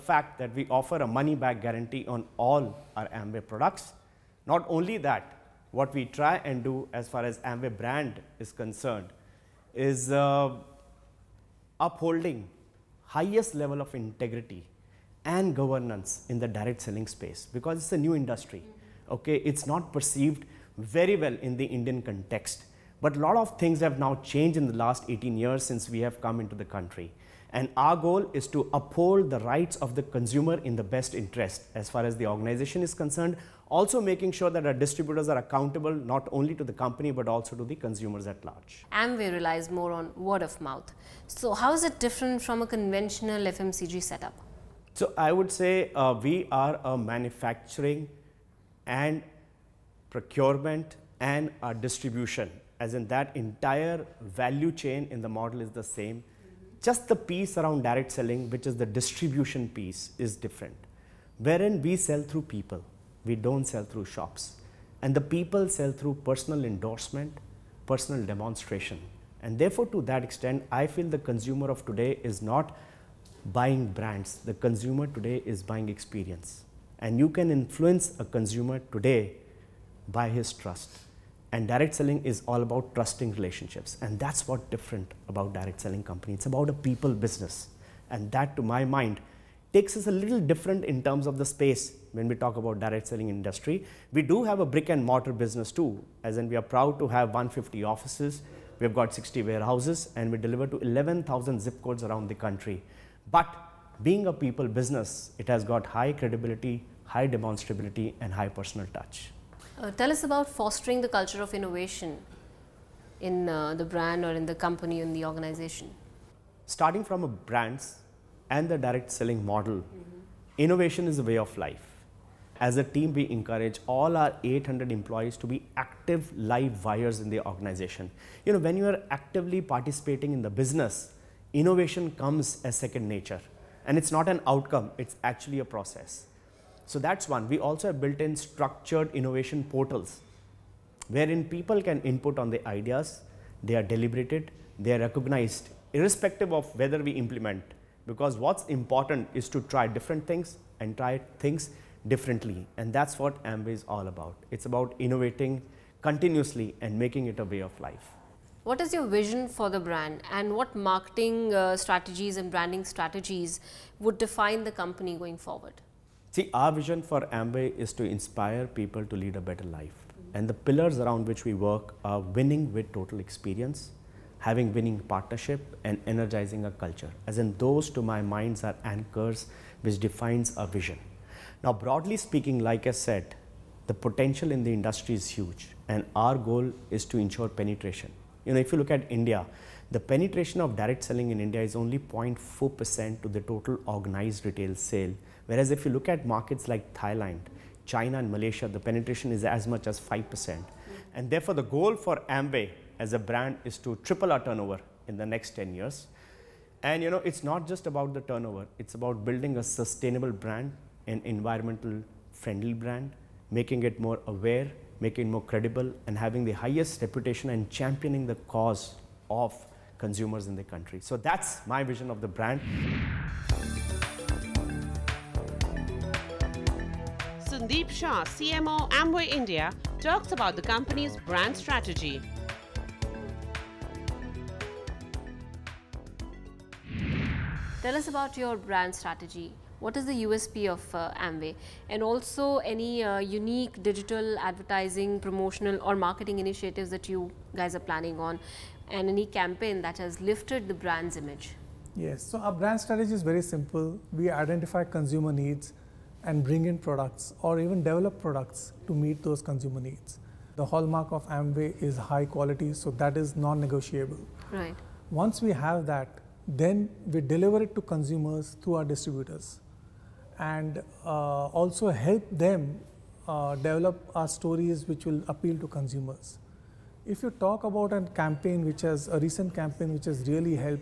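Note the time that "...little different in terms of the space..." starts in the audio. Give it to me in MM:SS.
01:30.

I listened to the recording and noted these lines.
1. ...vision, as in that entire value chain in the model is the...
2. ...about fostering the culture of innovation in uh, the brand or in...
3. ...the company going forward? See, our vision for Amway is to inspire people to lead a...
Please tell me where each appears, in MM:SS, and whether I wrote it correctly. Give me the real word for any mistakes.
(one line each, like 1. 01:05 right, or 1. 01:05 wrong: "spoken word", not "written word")
1. 00:51 wrong: "distribution", not "vision"
2. 01:50 right
3. 02:44 right.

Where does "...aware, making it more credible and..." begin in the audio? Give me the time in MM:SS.
03:34.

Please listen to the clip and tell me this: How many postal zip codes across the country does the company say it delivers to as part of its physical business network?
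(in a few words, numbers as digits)
11,000.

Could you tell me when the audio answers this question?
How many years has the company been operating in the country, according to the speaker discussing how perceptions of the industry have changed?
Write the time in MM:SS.
00:25.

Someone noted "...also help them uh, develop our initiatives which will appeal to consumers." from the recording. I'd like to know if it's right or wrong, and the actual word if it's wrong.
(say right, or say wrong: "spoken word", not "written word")
wrong: "stories", not "initiatives".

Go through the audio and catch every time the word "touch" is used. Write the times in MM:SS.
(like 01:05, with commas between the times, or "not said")
01:48.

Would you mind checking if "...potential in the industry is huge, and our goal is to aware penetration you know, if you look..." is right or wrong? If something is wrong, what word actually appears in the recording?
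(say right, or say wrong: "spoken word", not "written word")
wrong: "ensure", not "aware".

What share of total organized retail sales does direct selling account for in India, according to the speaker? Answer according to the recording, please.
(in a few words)
0.4%.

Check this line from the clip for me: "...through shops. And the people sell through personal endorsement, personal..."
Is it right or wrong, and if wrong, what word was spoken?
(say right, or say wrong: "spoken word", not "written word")
right.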